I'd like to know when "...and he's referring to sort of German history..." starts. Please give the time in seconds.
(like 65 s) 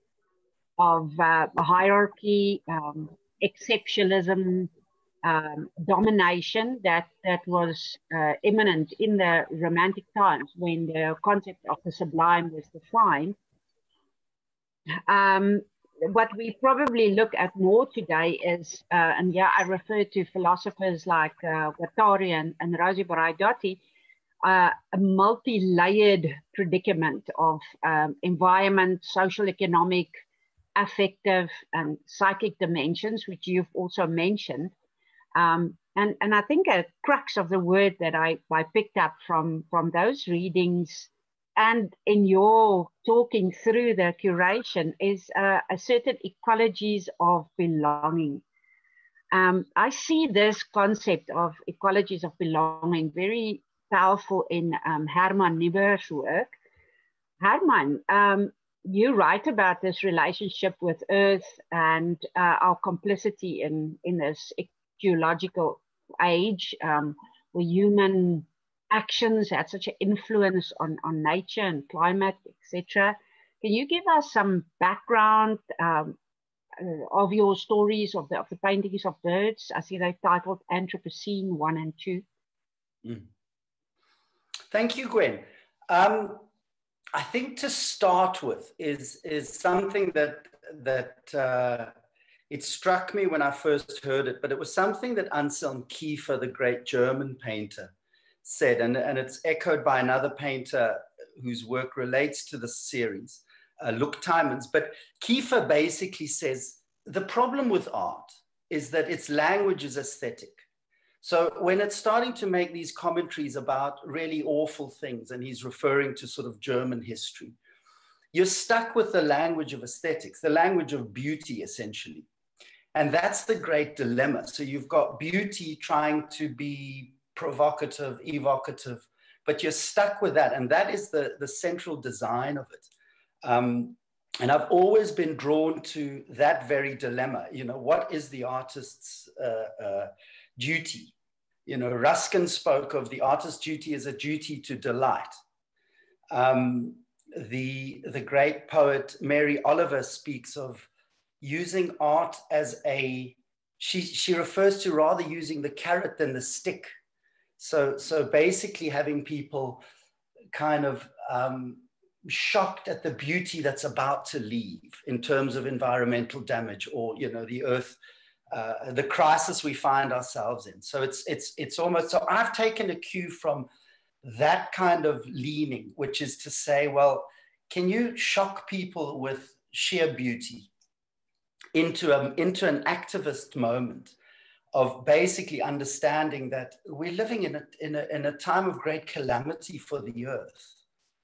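115 s.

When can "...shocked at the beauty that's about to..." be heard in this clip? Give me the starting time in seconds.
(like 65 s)
162 s.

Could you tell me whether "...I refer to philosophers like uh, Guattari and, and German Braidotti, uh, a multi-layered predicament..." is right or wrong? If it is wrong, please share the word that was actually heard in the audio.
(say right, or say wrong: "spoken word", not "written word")
wrong: "Rosi", not "German".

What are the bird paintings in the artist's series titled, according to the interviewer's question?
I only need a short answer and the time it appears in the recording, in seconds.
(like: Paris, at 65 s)
Anthropocene 1 and 2, at 80 s.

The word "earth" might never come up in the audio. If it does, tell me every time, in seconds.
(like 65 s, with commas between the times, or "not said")
61 s, 167 s, 190 s.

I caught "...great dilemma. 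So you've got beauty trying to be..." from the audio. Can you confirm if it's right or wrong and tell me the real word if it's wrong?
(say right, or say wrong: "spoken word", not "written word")
right.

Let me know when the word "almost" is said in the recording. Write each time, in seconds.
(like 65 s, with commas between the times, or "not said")
171 s.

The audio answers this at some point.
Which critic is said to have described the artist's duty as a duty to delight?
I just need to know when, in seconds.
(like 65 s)
141 s.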